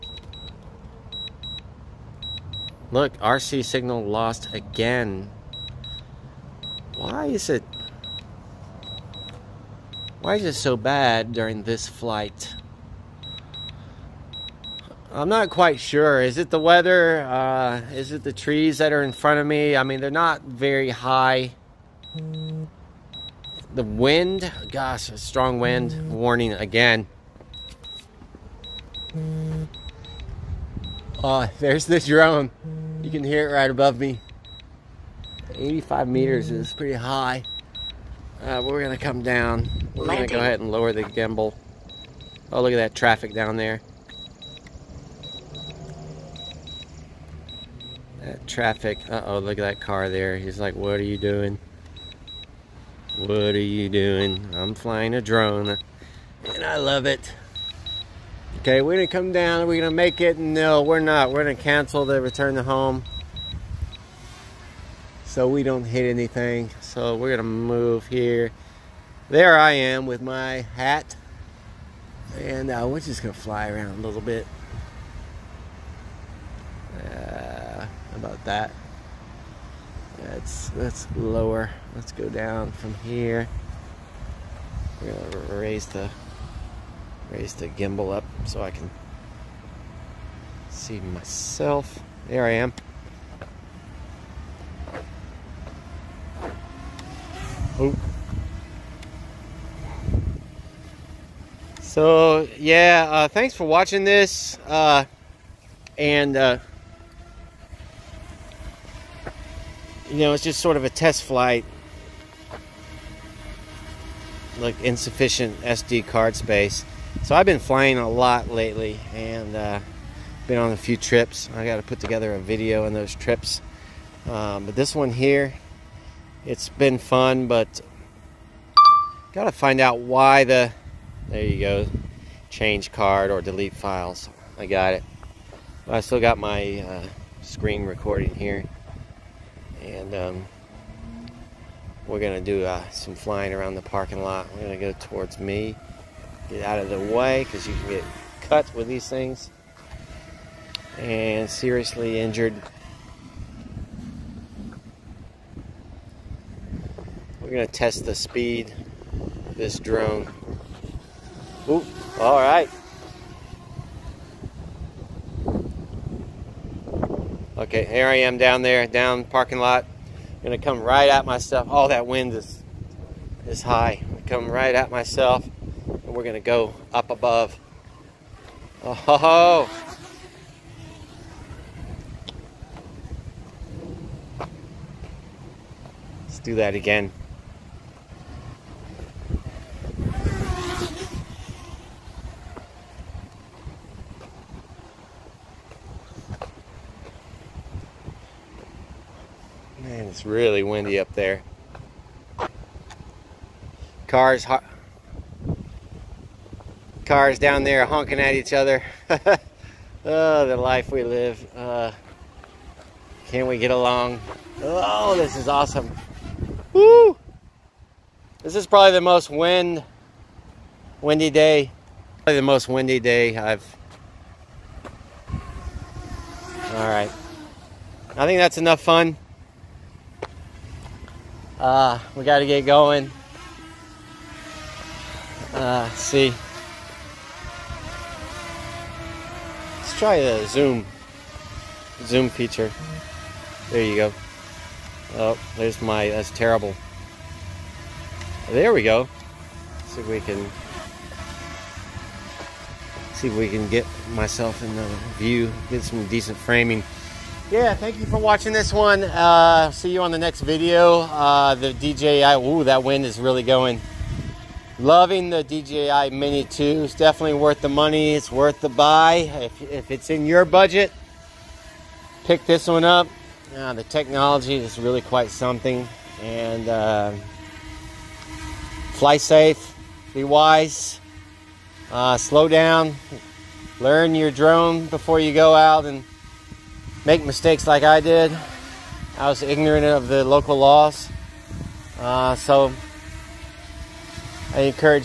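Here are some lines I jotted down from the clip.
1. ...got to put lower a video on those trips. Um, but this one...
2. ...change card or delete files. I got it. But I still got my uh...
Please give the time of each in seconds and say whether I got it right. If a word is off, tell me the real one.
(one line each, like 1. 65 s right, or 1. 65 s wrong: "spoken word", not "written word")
1. 121 s wrong: "together", not "lower"
2. 132 s right.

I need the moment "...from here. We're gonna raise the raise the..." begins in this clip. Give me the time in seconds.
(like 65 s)
82 s.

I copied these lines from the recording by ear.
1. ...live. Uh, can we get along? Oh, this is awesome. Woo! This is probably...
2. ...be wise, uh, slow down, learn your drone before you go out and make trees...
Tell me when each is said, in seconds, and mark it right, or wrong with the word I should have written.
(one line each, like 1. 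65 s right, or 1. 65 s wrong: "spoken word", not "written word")
1. 211 s right
2. 280 s wrong: "mistakes", not "trees".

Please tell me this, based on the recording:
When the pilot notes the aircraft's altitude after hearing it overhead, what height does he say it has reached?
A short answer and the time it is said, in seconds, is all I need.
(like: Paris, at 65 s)
85 meters, at 35 s.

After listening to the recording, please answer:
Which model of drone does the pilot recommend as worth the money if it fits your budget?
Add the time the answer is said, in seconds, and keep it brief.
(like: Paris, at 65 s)
DJI Mini 2, at 265 s.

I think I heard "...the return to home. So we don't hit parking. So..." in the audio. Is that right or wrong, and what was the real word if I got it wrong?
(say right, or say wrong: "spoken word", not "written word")
wrong: "anything", not "parking".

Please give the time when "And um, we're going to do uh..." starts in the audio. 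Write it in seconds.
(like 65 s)
139 s.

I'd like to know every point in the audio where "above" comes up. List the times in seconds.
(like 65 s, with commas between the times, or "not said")
33 s, 177 s.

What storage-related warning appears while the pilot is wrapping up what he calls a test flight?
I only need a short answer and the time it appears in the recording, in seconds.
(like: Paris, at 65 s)
Insufficient SD card space, at 114 s.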